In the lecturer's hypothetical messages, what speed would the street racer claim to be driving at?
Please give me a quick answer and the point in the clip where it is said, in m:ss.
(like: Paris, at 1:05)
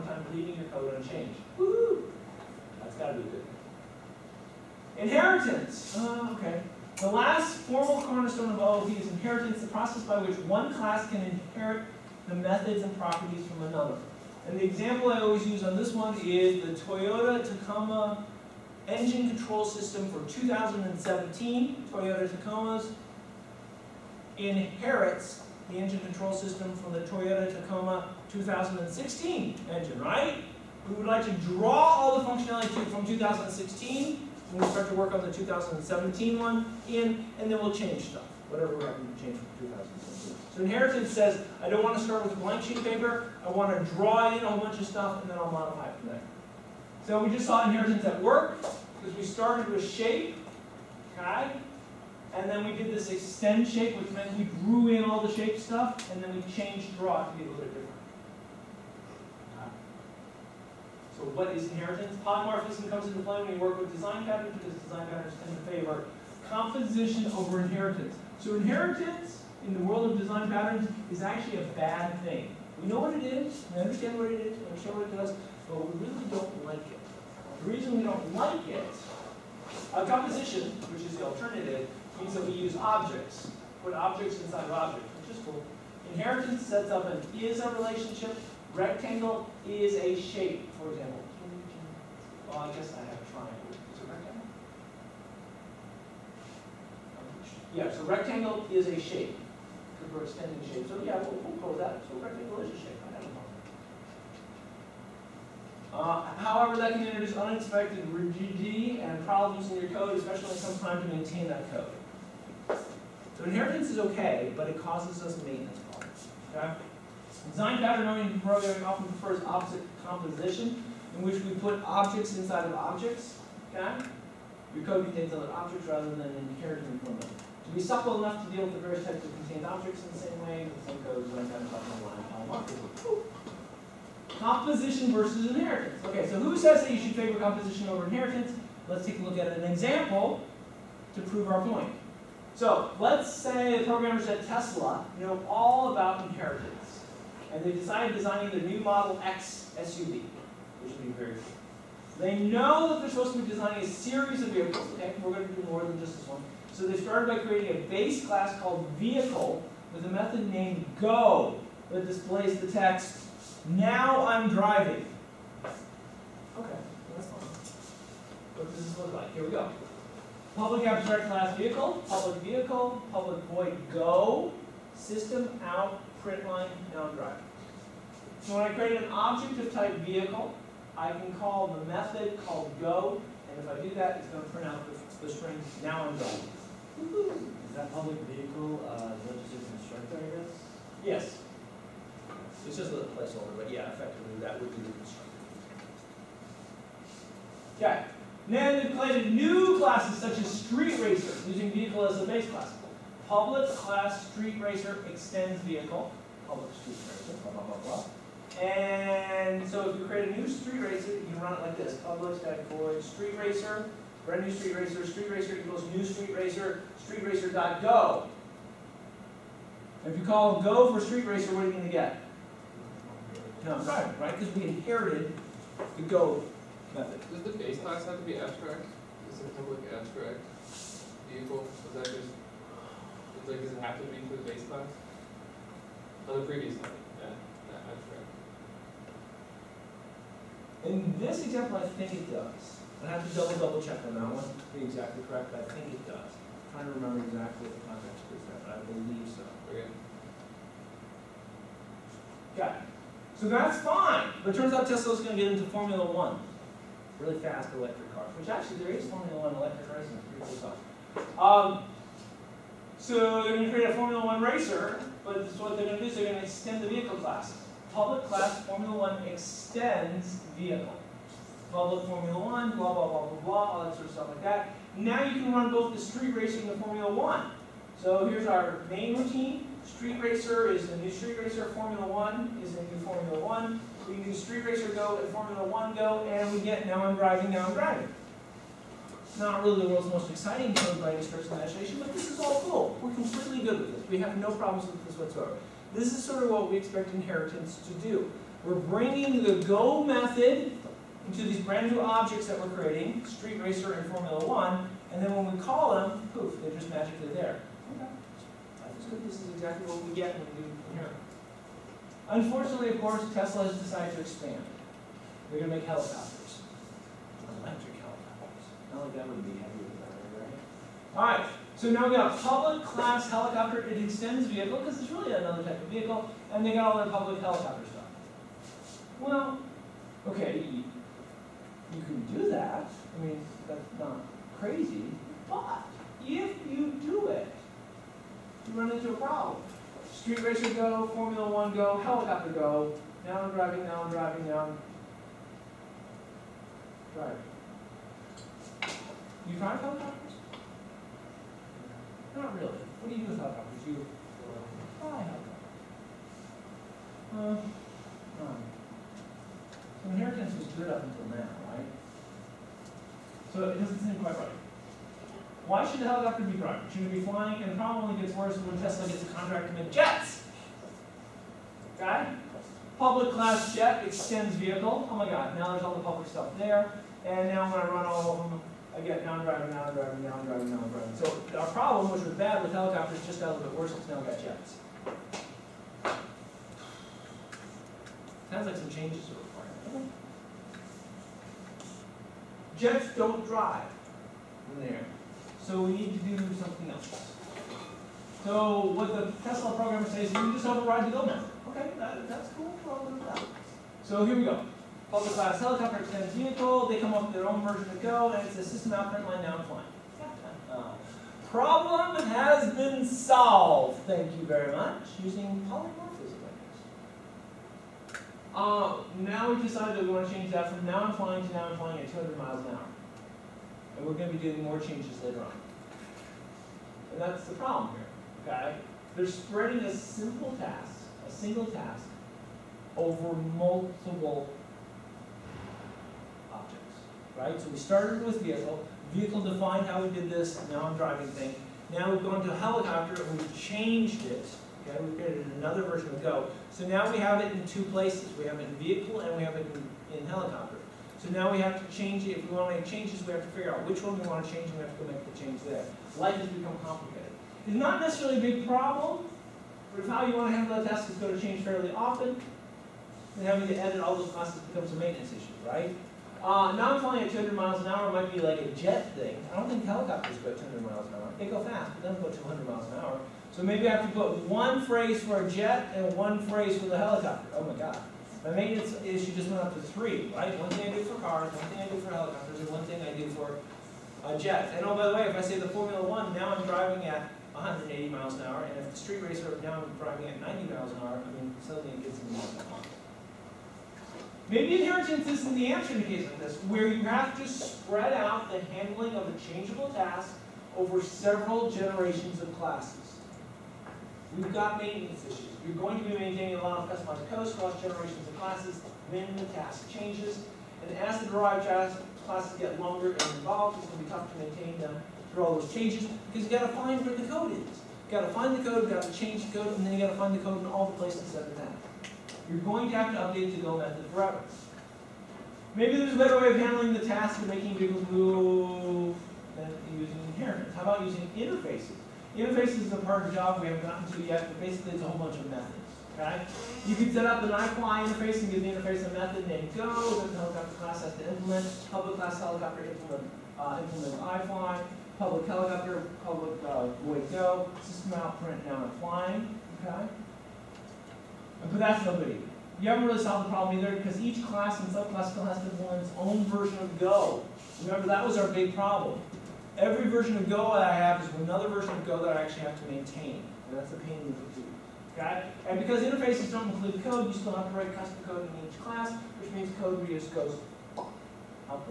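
90 miles an hour, at 8:10.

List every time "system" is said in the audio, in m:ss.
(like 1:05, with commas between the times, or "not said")
0:19, 0:26, 2:54, 6:48, 9:07.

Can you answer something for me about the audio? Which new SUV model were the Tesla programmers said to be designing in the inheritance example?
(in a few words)
Model X.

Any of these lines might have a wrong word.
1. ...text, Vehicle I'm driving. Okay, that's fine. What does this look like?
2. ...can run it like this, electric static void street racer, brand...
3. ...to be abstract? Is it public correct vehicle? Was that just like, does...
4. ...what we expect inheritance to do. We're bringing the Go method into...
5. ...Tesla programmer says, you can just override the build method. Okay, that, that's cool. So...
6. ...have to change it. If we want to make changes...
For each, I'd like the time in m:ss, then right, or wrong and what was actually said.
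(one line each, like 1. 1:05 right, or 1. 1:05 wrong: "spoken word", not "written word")
1. 2:42 wrong: "Now", not "Vehicle"
2. 3:31 wrong: "public", not "electric"
3. 3:48 wrong: "abstract", not "correct"
4. 4:56 right
5. 6:39 right
6. 7:31 right.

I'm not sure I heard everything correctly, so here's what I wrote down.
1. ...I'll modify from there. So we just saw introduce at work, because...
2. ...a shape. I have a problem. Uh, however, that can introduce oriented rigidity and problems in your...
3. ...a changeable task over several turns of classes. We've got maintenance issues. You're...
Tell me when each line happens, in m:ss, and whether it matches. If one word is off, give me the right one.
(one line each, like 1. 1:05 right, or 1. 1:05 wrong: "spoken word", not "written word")
1. 0:45 wrong: "inheritance", not "introduce"
2. 1:42 wrong: "unexpected", not "oriented"
3. 8:19 wrong: "generations", not "turns".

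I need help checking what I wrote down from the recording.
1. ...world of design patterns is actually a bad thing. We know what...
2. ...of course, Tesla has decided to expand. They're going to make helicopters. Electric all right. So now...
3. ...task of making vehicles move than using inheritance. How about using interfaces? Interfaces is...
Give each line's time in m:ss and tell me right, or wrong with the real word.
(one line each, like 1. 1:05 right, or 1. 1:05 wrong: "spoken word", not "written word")
1. 1:09 right
2. 5:12 right
3. 8:46 right.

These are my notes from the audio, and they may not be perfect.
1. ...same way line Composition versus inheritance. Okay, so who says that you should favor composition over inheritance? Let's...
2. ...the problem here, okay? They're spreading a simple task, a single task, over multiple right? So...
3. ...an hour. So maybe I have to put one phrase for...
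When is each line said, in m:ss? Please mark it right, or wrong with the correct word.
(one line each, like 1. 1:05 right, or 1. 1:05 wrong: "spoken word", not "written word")
1. 2:10 right
2. 7:07 right
3. 7:52 right.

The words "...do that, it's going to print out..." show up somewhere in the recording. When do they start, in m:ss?
3:03.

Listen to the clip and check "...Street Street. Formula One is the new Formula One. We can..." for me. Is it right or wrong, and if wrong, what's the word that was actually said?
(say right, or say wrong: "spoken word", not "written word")
wrong: "Racer", not "Street".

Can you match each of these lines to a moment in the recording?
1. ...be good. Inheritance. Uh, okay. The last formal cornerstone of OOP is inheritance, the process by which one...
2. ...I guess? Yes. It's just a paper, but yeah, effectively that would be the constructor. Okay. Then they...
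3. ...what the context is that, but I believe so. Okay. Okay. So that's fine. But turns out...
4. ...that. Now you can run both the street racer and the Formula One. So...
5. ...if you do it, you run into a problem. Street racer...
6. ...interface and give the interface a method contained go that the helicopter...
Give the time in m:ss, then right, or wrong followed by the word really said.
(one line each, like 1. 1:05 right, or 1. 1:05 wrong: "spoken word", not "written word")
1. 0:03 right
2. 3:10 wrong: "placeholder", not "paper"
3. 4:07 right
4. 4:34 right
5. 5:36 right
6. 8:58 wrong: "named", not "contained".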